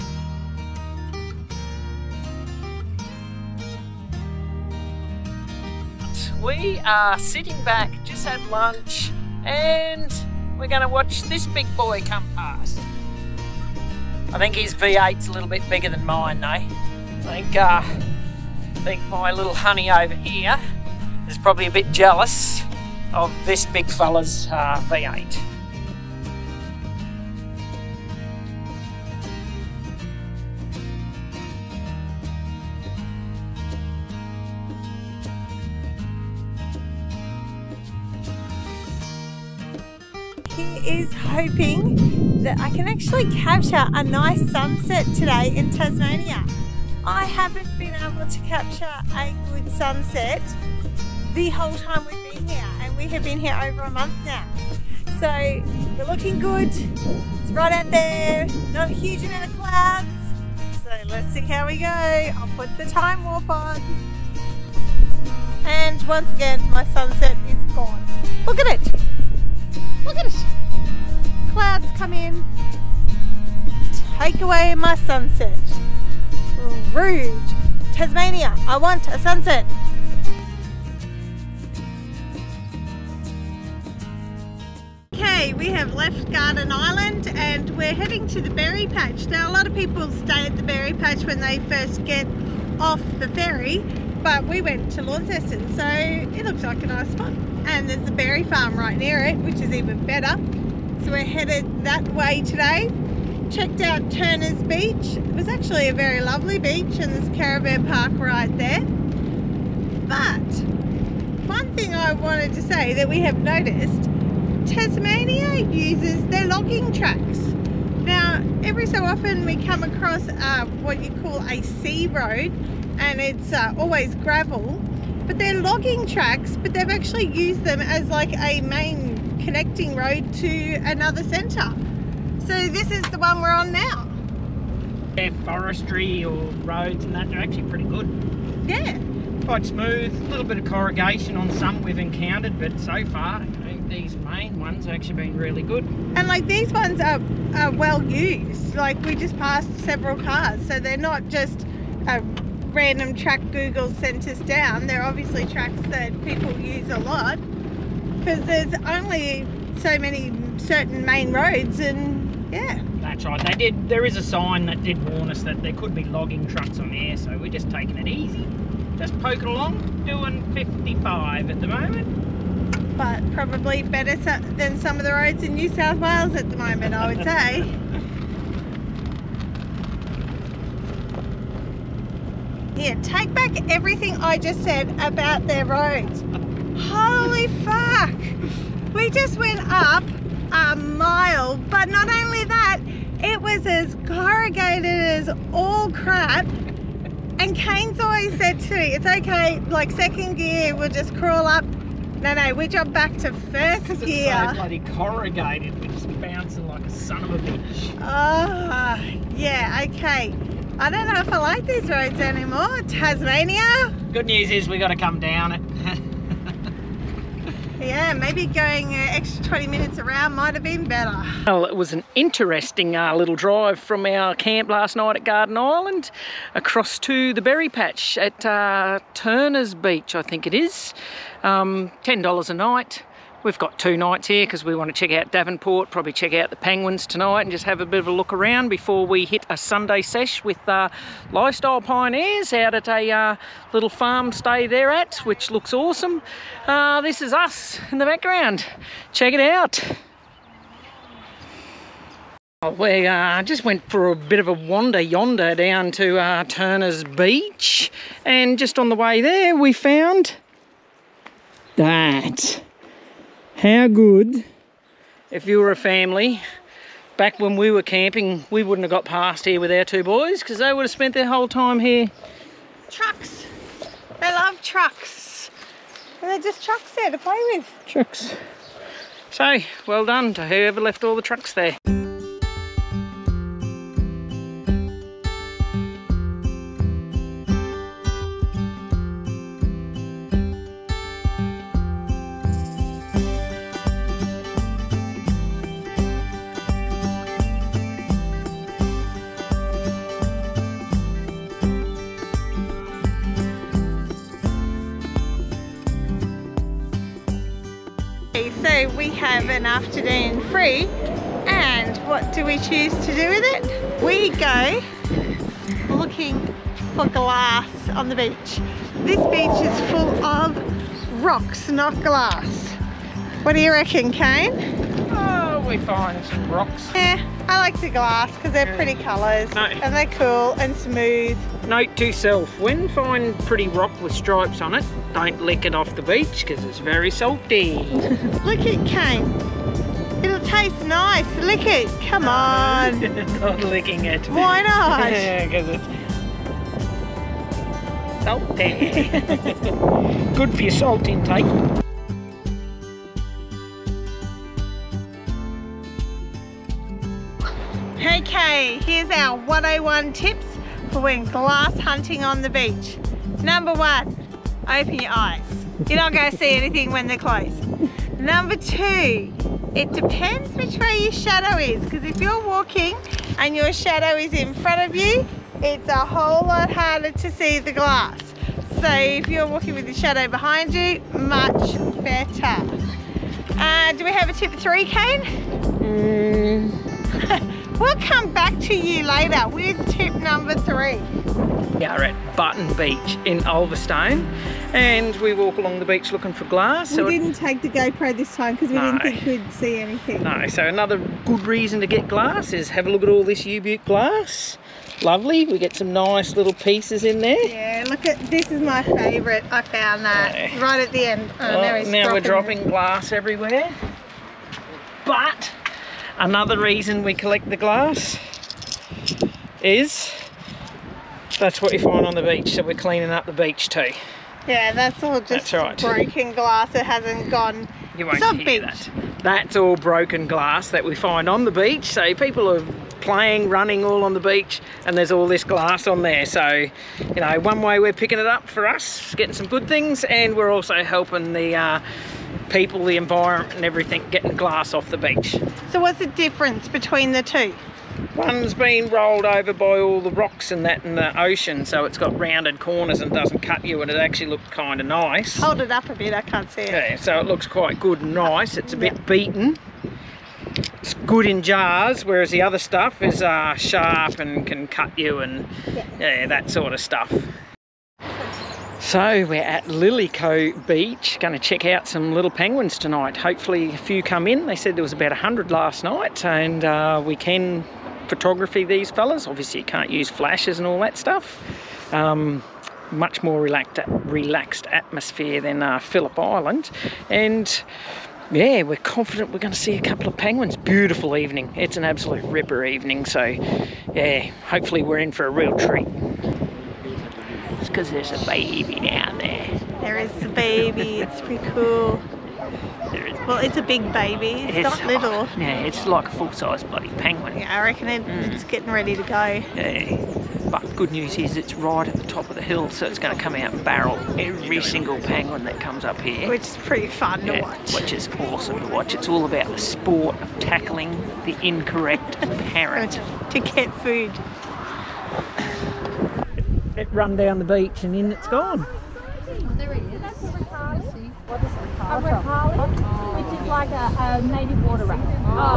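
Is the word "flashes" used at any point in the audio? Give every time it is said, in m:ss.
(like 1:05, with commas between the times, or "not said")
8:00.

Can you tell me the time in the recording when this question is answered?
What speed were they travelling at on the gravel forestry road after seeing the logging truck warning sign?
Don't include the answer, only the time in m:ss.
2:50.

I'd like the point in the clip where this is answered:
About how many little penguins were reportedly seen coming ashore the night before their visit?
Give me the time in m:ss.
7:55.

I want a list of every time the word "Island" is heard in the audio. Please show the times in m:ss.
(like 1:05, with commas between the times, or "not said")
1:26, 3:45, 8:06.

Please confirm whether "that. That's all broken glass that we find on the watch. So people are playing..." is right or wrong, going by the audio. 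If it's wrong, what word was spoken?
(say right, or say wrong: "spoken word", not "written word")
wrong: "beach", not "watch".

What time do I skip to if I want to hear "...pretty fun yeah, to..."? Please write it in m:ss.
8:36.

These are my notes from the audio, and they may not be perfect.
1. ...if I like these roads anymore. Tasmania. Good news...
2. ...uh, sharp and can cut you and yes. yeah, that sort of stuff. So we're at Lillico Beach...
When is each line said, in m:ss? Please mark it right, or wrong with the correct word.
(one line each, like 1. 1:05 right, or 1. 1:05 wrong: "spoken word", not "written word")
1. 3:31 right
2. 7:43 right.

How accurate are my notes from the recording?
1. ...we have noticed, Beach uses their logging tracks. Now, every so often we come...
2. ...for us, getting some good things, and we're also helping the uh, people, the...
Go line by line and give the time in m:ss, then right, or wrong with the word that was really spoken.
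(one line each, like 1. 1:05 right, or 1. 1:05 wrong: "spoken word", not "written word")
1. 1:53 wrong: "Tasmania", not "Beach"
2. 7:18 right.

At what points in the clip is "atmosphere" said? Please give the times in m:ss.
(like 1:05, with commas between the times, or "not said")
8:04.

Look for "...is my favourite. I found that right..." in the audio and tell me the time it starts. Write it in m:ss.
6:48.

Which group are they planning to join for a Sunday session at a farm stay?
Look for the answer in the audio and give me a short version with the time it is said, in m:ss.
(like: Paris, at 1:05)
Lifestyle Pioneers, at 4:01.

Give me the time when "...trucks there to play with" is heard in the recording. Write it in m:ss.
4:36.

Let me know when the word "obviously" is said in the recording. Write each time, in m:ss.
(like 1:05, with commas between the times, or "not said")
2:35, 7:59.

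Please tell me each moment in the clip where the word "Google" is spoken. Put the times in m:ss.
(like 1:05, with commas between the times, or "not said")
2:33.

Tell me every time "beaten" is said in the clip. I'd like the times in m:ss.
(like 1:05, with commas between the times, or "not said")
7:39.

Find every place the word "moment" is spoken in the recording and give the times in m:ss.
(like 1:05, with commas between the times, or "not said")
2:51, 2:56.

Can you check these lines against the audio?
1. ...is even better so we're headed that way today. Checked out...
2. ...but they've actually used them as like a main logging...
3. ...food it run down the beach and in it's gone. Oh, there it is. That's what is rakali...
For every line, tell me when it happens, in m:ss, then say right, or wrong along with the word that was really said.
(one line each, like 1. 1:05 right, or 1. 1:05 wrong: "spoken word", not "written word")
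1. 1:39 right
2. 2:06 wrong: "connecting", not "logging"
3. 8:43 right.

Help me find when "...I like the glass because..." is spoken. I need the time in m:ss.
5:27.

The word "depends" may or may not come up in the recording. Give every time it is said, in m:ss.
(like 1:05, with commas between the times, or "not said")
6:09.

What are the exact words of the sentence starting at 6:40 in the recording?
No, so another good reason to get glass is have a look at all this U-Butte glass.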